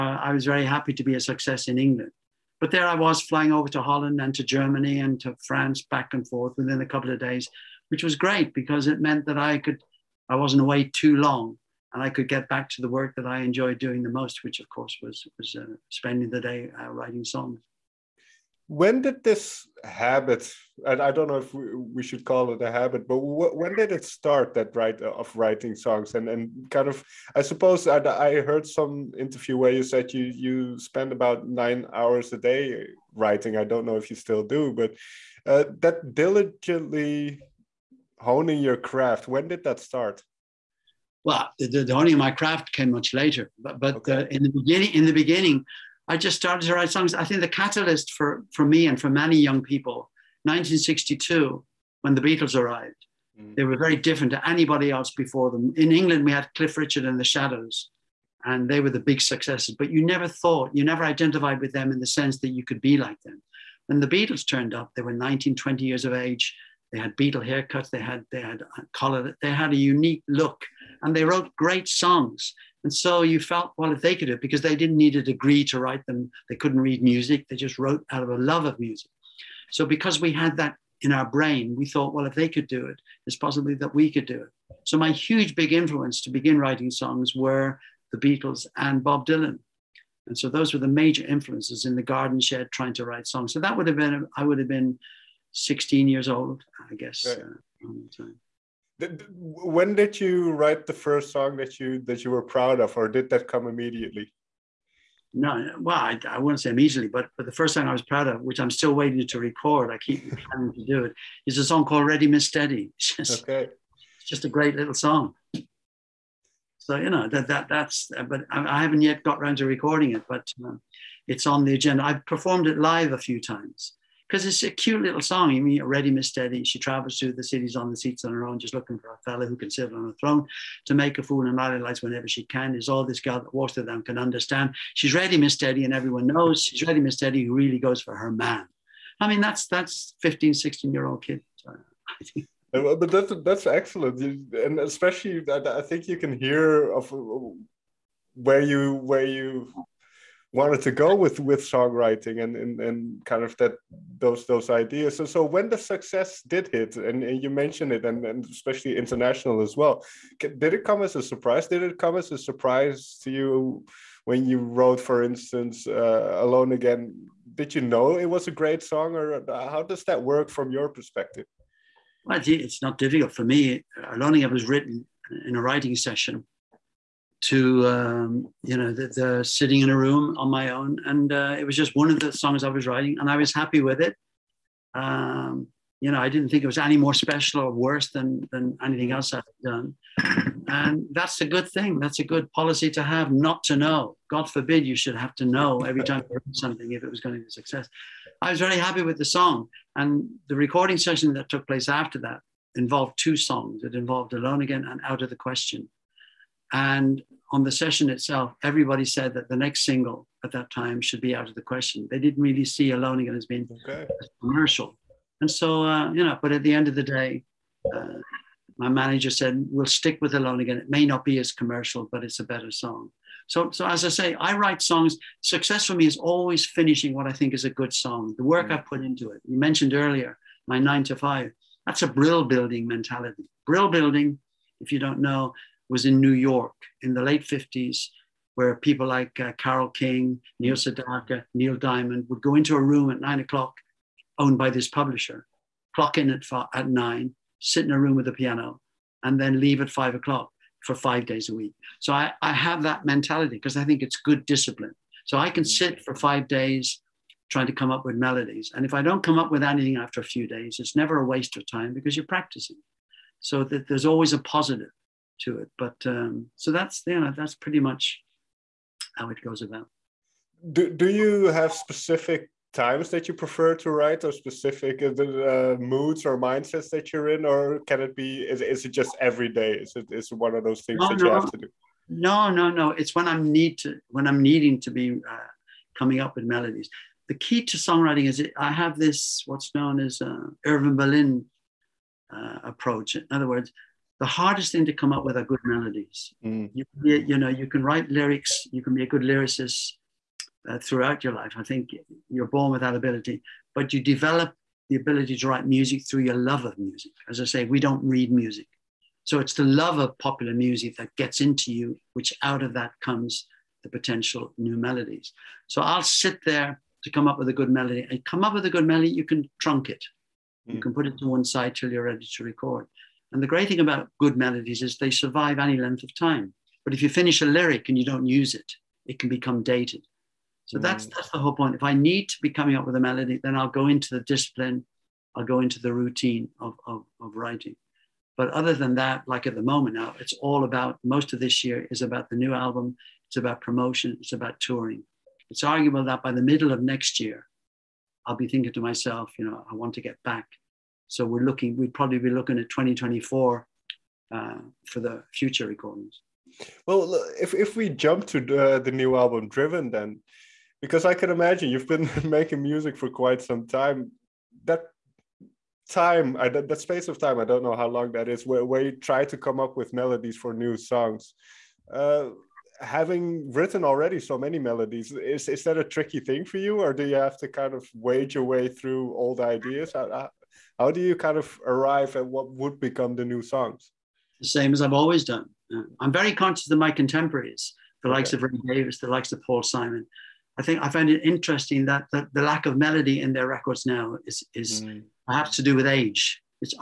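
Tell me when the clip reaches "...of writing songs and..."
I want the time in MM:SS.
00:25.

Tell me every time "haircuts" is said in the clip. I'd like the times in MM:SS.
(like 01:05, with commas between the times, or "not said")
01:07.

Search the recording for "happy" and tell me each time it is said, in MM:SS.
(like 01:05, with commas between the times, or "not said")
00:00, 03:03, 03:18.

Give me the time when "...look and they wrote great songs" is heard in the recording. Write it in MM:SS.
01:10.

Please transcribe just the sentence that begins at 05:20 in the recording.
You can put it to one side till you're ready to record.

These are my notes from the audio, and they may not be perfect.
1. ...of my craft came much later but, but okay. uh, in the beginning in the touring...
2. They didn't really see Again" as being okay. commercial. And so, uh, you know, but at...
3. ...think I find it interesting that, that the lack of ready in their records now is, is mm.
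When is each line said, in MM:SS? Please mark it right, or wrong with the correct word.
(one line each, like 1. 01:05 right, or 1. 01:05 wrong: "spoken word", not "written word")
1. 00:42 wrong: "beginning", not "touring"
2. 03:32 right
3. 06:30 wrong: "melody", not "ready".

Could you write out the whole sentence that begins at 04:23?
So that there's always a positive to it.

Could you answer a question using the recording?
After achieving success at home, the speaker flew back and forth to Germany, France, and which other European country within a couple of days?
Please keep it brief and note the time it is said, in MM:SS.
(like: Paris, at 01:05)
Holland, at 00:03.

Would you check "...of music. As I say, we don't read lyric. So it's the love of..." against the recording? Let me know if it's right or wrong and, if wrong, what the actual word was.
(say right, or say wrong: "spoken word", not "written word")
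wrong: "music", not "lyric".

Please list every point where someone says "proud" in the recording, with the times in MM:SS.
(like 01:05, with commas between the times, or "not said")
01:42, 01:48.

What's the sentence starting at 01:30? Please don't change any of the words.
And so those were the major influences in the garden shed trying to write songs.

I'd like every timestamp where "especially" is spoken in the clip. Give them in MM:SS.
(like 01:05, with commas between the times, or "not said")
02:24, 02:38.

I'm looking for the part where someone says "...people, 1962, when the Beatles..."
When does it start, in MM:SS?
00:49.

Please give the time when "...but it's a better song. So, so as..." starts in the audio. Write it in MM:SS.
03:42.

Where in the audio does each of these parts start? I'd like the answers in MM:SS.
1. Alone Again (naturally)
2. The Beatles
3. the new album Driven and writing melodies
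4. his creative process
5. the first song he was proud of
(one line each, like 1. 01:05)
1. 02:51
2. 00:39
3. 05:56
4. 04:29
5. 01:37.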